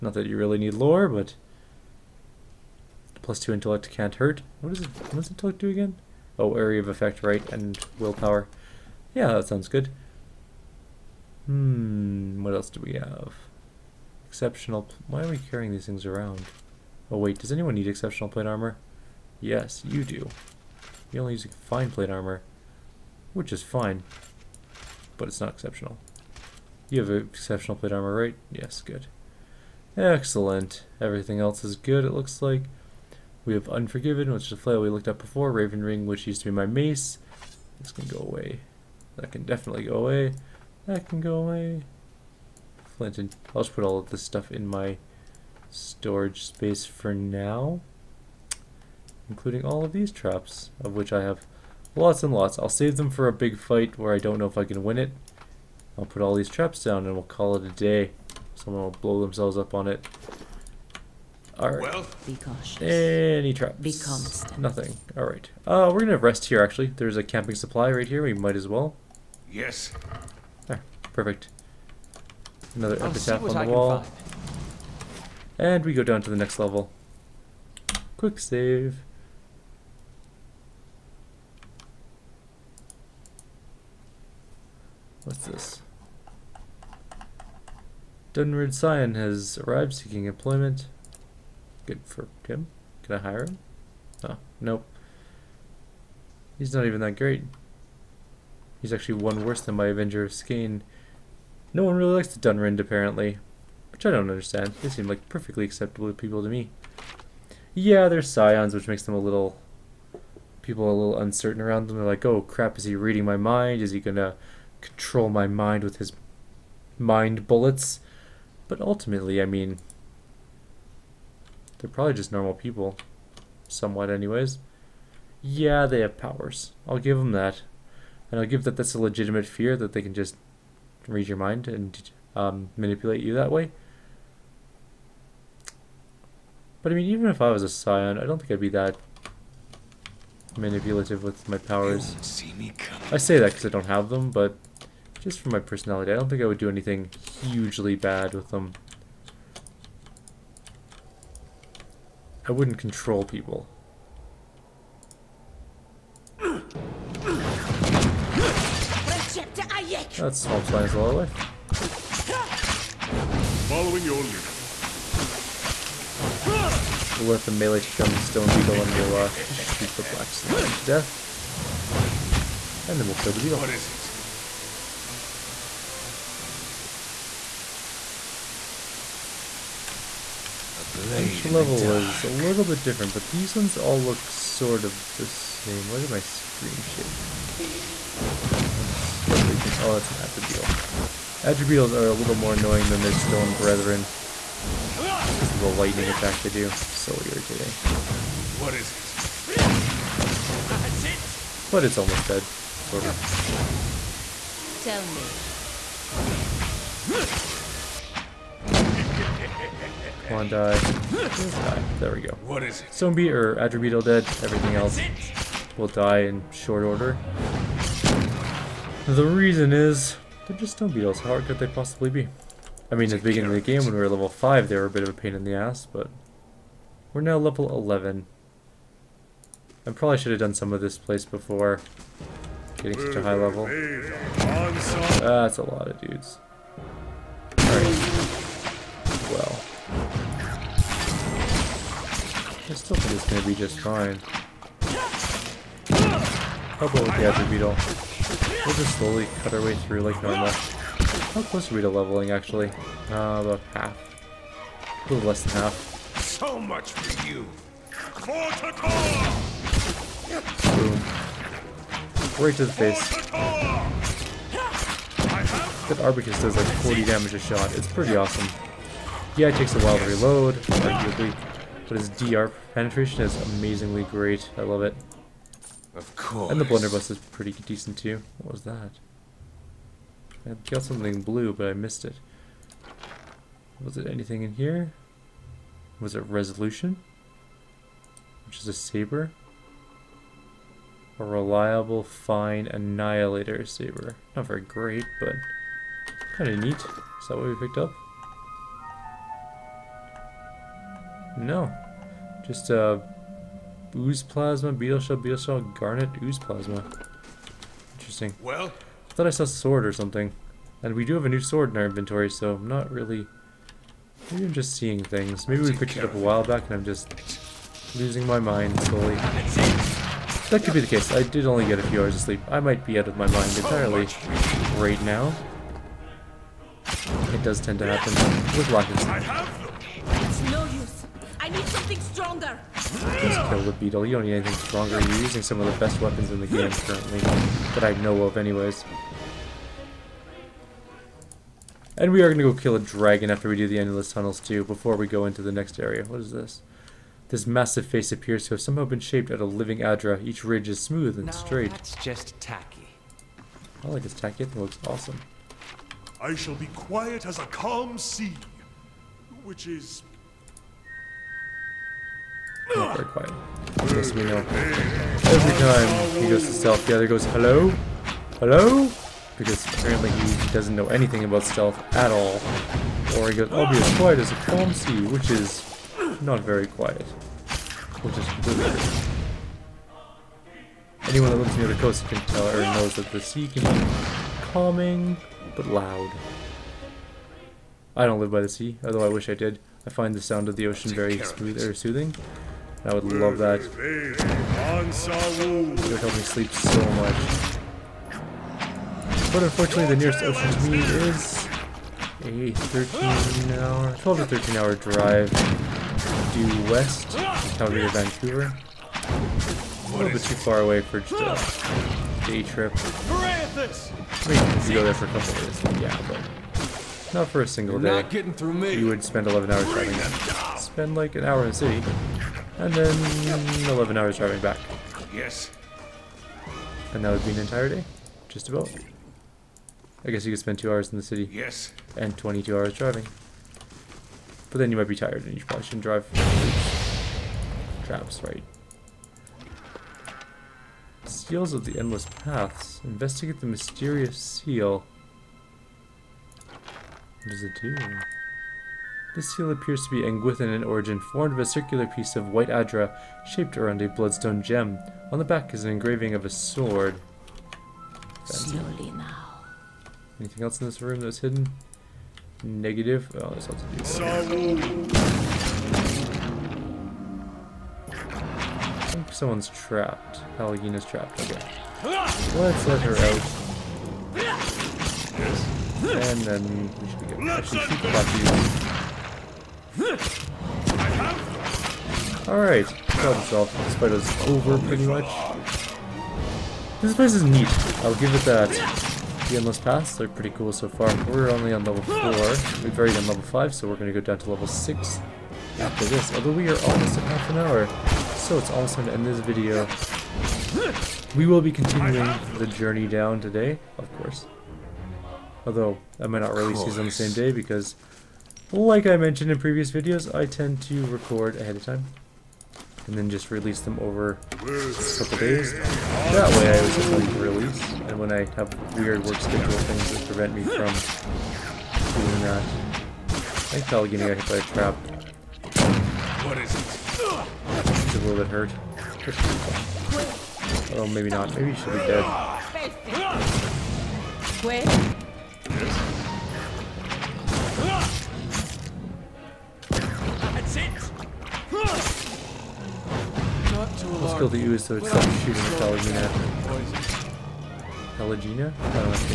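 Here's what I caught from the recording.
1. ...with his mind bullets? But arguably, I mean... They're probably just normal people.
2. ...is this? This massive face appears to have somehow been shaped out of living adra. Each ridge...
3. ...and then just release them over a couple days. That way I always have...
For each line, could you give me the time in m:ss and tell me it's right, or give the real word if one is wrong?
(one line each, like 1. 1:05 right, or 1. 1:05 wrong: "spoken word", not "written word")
1. 1:55 wrong: "ultimately", not "arguably"
2. 5:46 right
3. 8:32 right.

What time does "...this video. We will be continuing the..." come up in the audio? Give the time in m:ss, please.
8:19.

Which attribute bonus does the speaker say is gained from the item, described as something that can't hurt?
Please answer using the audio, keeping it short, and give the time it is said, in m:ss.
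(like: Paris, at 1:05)
plus two intellect, at 0:03.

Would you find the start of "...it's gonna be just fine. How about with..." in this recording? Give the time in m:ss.
4:03.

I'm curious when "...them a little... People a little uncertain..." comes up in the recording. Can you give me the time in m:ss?
1:49.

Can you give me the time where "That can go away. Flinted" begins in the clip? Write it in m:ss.
0:40.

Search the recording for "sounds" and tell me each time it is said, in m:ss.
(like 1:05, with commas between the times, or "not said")
0:09, 6:30.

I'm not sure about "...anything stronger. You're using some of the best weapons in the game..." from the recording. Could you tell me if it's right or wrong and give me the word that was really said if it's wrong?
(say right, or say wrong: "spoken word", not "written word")
right.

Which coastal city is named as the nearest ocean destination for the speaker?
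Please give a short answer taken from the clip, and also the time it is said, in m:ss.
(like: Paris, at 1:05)
Vancouver, at 6:47.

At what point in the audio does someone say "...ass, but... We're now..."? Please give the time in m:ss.
3:45.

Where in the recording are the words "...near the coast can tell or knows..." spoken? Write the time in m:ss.
6:21.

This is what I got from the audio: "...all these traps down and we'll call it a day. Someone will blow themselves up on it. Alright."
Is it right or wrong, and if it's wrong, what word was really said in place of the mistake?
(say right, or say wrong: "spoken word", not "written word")
right.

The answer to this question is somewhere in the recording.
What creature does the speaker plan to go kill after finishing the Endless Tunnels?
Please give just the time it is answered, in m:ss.
5:42.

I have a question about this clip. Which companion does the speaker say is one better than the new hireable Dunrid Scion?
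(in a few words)
Avenger of Skaen.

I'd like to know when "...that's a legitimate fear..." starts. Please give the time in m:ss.
2:08.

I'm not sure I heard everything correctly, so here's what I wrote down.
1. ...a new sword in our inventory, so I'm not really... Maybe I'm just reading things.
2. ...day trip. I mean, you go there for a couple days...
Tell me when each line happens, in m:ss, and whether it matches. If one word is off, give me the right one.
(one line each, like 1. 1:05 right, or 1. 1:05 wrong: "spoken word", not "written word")
1. 5:11 wrong: "seeing", not "reading"
2. 6:52 right.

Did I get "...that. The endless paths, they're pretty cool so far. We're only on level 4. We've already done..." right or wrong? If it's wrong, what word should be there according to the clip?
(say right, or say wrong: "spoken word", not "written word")
right.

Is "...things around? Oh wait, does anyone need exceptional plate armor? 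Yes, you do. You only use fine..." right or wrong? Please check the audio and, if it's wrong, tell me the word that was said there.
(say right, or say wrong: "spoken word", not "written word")
right.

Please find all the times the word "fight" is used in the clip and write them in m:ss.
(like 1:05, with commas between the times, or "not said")
0:53, 8:03.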